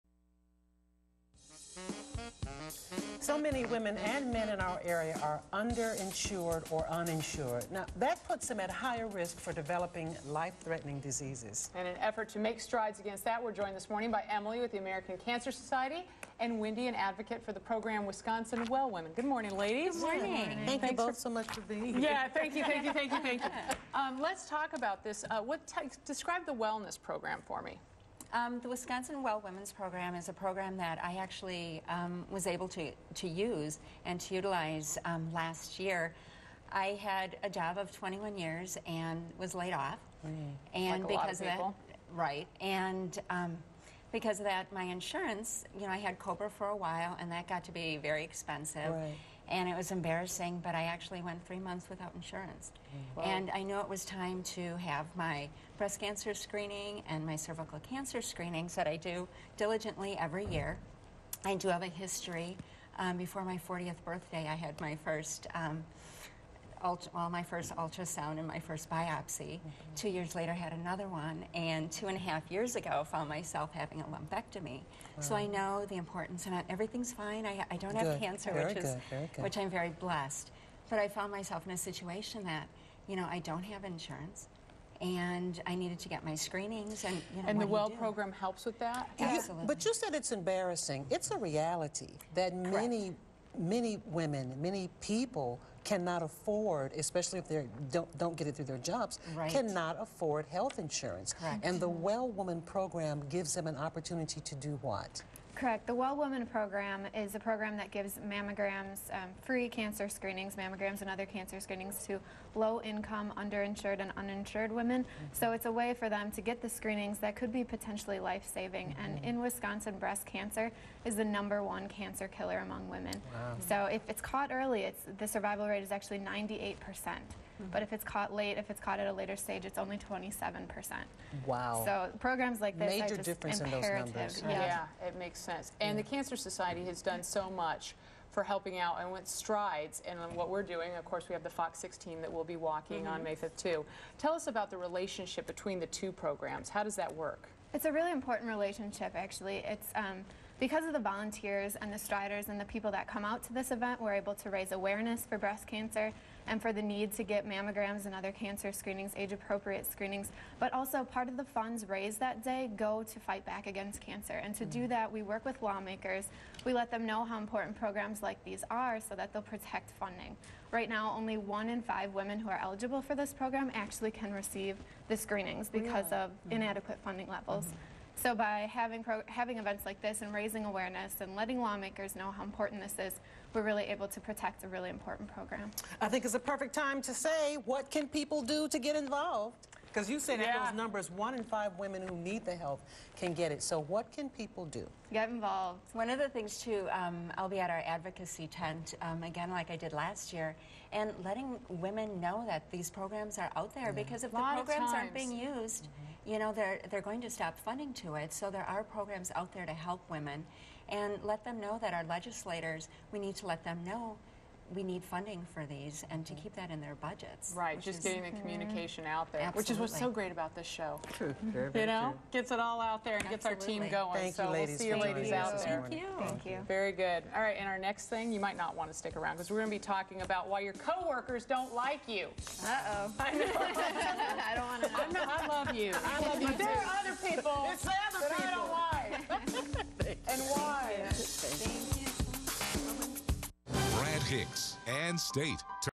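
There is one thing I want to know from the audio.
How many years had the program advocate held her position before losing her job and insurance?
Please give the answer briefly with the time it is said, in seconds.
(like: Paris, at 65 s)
21, at 37 s.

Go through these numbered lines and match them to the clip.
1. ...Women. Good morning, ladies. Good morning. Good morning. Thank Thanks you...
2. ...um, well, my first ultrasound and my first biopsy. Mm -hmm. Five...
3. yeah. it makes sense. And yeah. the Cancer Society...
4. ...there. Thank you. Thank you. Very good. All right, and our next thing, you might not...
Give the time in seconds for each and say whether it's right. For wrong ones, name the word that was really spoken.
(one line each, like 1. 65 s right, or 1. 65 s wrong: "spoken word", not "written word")
1. 18 s right
2. 65 s wrong: "Two", not "Five"
3. 135 s right
4. 225 s right.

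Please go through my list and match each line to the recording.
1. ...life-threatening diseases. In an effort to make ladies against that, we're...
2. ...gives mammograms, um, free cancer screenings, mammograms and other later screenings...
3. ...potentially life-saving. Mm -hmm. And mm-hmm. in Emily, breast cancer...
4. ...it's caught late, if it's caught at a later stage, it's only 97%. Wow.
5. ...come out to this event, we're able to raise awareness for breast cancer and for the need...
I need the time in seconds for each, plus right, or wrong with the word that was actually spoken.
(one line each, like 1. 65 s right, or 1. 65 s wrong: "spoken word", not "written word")
1. 10 s wrong: "strides", not "ladies"
2. 107 s wrong: "cancer", not "later"
3. 117 s wrong: "Wisconsin", not "Emily"
4. 127 s wrong: "27", not "97"
5. 153 s right.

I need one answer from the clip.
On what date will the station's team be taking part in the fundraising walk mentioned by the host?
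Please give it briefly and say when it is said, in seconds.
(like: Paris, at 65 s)
May 5th, at 143 s.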